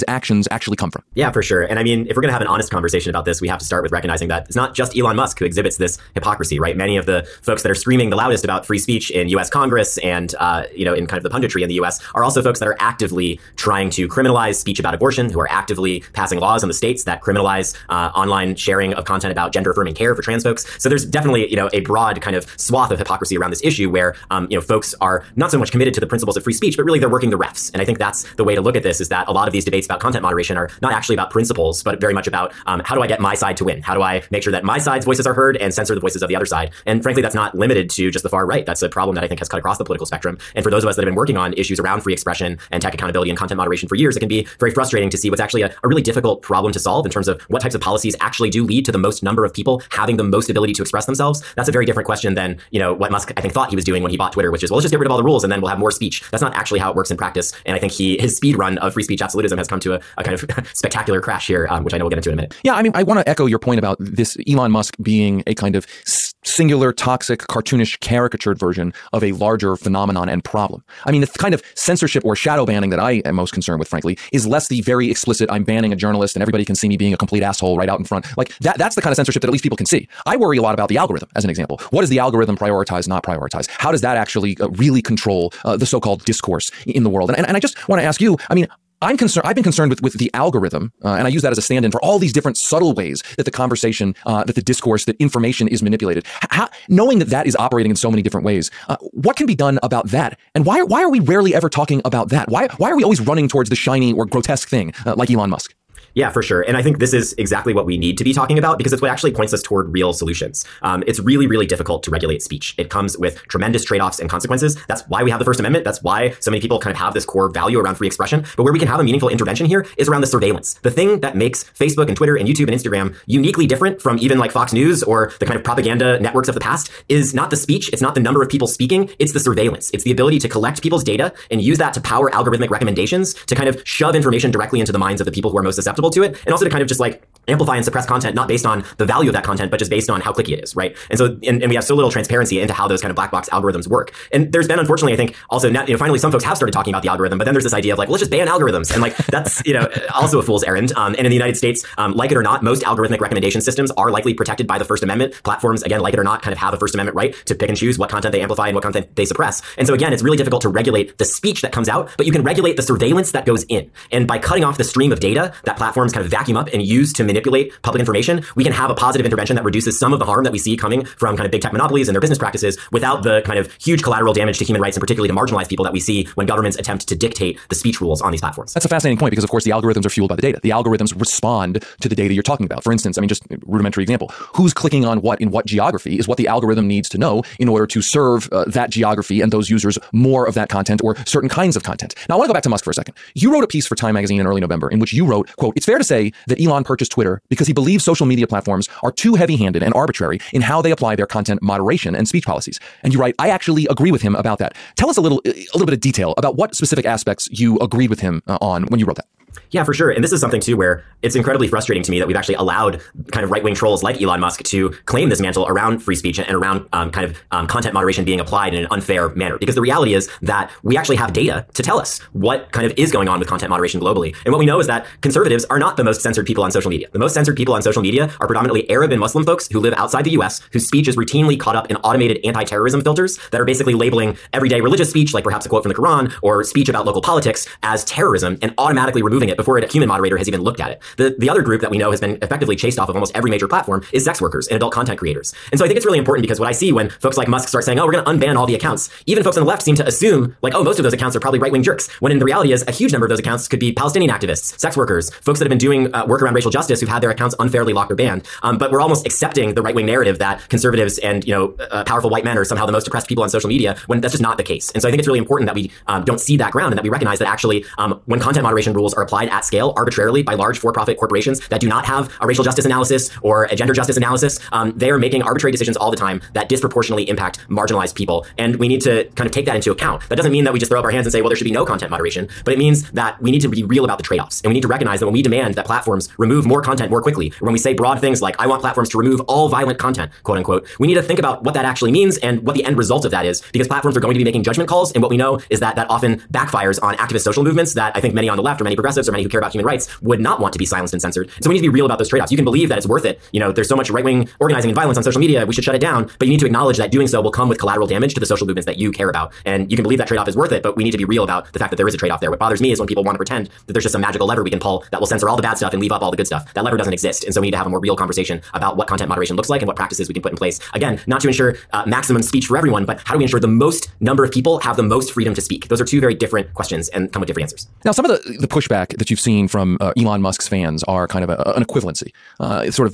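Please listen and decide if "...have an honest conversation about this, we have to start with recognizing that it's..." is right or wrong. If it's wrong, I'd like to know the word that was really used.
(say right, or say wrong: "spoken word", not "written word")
right.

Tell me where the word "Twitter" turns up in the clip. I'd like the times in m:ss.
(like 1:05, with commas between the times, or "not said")
0:54, 2:02, 3:17.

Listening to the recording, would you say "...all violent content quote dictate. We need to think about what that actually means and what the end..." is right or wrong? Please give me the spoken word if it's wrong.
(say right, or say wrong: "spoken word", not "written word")
wrong: "unquote", not "dictate".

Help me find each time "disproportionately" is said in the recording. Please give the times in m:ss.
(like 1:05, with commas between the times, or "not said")
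4:36.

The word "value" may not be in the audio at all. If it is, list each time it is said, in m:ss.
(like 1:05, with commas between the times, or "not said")
1:57, 2:19.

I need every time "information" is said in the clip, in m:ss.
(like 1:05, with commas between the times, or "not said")
1:35, 2:14, 2:47.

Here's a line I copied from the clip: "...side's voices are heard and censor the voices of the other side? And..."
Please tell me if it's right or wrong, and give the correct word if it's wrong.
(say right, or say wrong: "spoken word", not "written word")
right.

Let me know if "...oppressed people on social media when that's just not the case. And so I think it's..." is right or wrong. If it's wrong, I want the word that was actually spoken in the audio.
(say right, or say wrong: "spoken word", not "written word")
right.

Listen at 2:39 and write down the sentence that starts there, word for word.
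And so again, it's really difficult to regulate the speech that comes out, but you can regulate the surveillance that goes in.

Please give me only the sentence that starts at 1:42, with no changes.
Why why are we always running towards the shiny or grotesque thing uh, like Elon Musk?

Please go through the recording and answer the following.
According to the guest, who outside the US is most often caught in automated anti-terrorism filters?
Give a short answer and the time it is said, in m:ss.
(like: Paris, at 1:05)
Arab and Muslim folks, at 3:48.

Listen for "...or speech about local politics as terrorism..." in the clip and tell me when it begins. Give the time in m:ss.
3:56.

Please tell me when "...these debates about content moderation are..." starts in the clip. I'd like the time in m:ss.
0:29.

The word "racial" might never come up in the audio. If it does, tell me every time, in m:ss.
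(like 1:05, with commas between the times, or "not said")
4:16, 4:32.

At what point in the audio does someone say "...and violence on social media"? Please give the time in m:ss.
5:04.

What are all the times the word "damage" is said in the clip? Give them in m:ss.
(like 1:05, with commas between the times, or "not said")
2:54, 5:08.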